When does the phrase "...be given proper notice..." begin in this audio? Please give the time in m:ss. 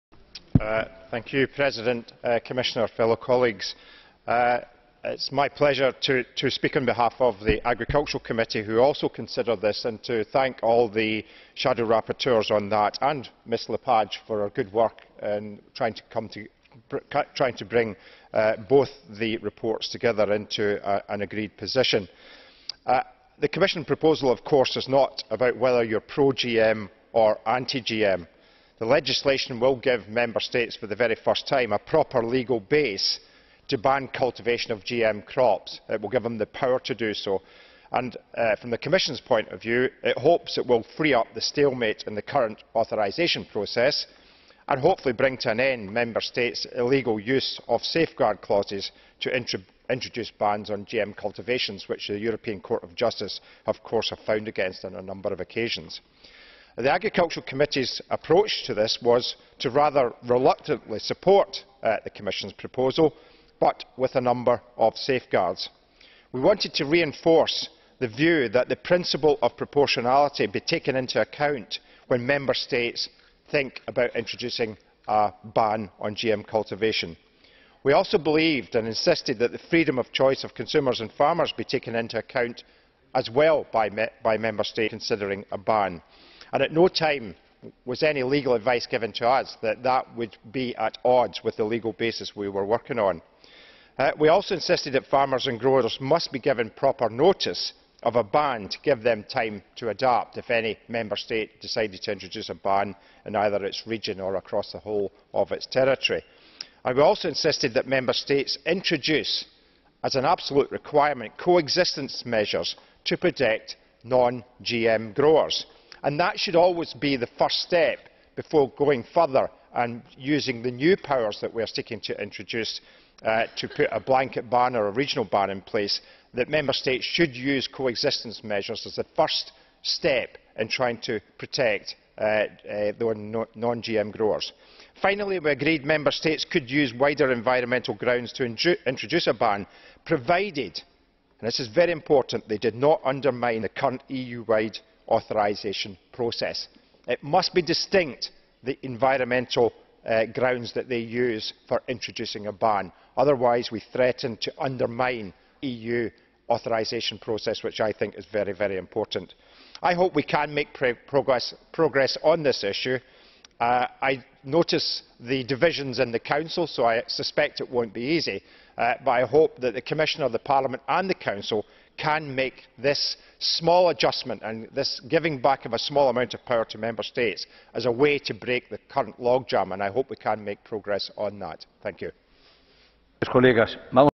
1:36.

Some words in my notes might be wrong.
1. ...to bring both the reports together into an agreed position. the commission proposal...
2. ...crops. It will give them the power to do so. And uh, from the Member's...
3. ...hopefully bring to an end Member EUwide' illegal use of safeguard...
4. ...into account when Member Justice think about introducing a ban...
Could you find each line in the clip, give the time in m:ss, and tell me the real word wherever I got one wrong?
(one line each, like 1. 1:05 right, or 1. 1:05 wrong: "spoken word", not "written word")
1. 0:15 right
2. 0:35 wrong: "Commission", not "Member"
3. 0:44 wrong: "States", not "EUwide"
4. 1:10 wrong: "States", not "Justice".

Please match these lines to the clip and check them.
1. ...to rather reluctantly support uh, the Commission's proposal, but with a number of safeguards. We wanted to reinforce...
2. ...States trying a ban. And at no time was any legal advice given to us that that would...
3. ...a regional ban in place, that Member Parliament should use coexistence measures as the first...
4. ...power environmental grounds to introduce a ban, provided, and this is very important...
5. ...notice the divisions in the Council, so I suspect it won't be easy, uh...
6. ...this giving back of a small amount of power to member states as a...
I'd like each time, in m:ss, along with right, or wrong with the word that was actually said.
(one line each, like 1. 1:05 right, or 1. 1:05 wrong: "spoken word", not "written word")
1. 0:59 right
2. 1:24 wrong: "considering", not "trying"
3. 2:04 wrong: "States", not "Parliament"
4. 2:16 wrong: "wider", not "power"
5. 2:44 right
6. 2:54 right.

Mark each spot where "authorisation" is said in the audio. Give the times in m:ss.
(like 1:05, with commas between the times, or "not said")
0:42, 2:25, 2:36.